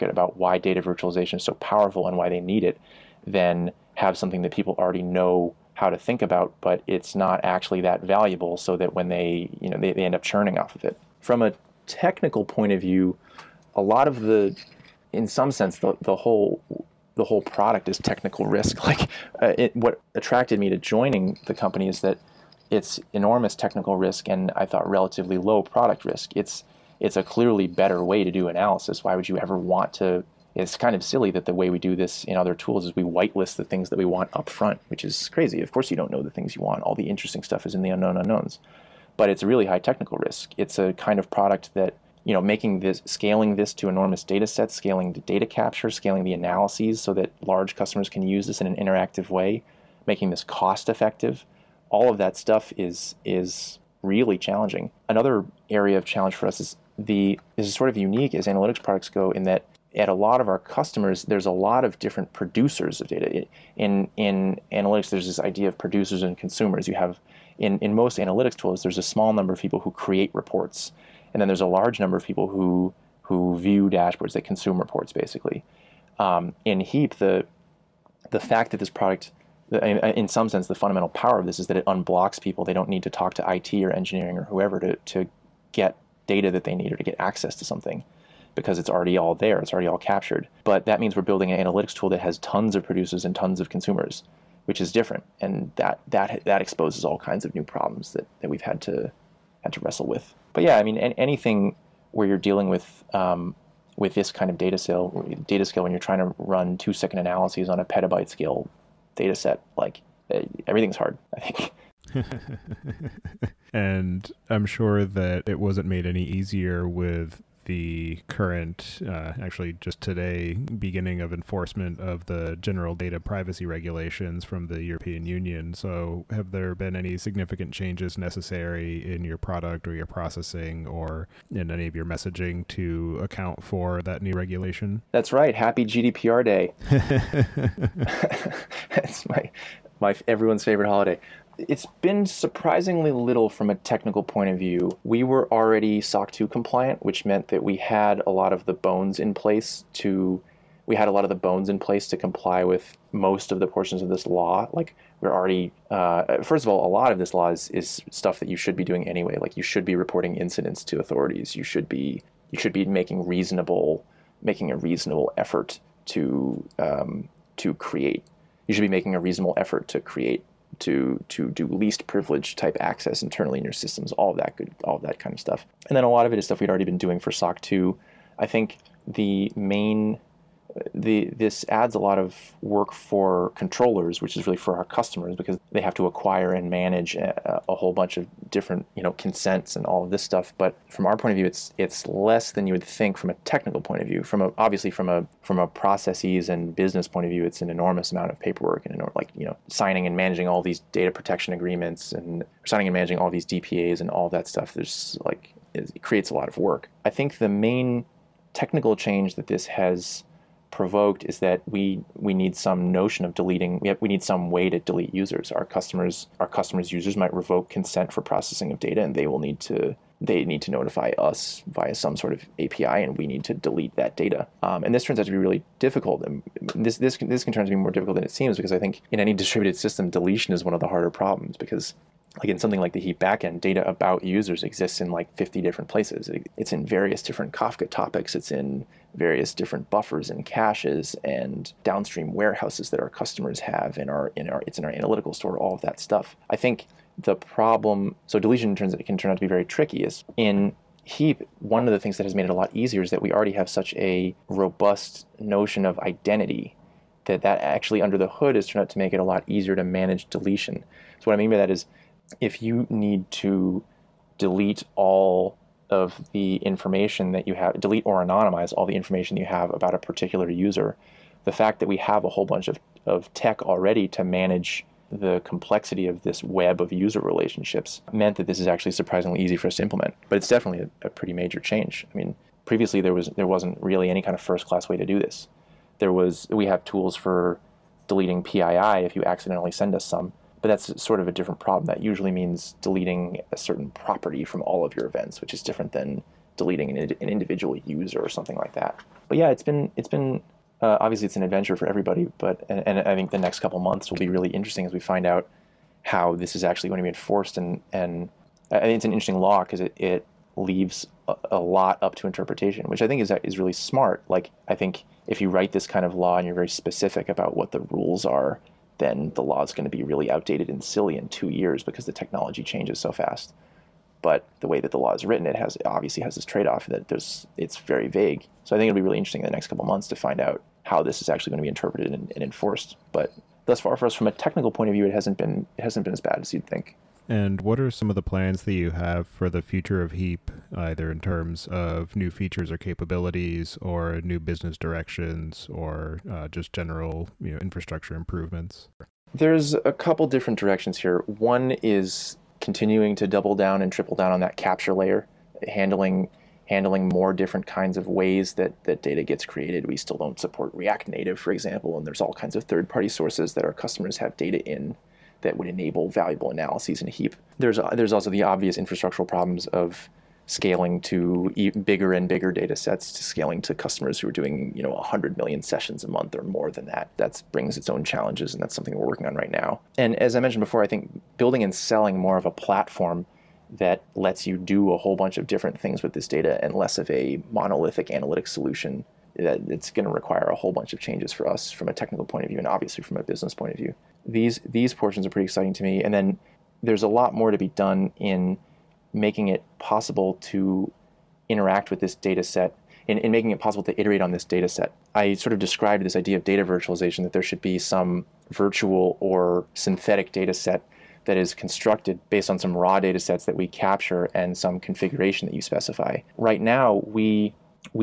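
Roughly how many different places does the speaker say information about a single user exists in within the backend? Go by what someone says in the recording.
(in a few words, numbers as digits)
50.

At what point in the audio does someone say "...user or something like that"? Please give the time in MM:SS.
04:57.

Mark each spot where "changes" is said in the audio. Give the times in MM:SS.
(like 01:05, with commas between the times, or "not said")
02:07, 03:28, 04:41, 05:22, 06:30.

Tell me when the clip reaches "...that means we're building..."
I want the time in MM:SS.
01:30.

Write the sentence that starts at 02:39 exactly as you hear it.
Like you should be reporting incidents to authorities.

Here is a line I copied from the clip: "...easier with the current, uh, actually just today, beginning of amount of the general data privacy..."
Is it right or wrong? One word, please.
wrong.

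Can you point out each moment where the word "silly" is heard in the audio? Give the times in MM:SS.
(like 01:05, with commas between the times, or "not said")
00:31, 05:20.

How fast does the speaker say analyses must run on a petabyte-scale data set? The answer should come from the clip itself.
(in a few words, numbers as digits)
2 seconds.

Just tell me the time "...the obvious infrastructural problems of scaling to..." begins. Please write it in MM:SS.
06:08.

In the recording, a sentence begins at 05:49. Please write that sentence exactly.
There's a couple different directions here.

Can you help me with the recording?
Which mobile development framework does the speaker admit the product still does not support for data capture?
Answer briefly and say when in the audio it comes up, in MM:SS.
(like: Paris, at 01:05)
React Native, at 06:00.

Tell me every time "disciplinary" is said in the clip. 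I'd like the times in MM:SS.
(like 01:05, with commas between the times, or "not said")
not said.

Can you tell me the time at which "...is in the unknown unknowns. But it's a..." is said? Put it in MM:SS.
00:37.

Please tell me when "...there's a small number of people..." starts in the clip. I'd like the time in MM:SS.
01:08.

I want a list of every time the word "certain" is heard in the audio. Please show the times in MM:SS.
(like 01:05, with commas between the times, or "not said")
04:53.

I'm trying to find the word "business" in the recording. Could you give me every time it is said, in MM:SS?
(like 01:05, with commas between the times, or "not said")
03:16, 05:44, 06:33.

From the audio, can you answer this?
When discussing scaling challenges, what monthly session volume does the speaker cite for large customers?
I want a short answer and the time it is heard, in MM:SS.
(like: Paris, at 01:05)
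100 million, at 06:14.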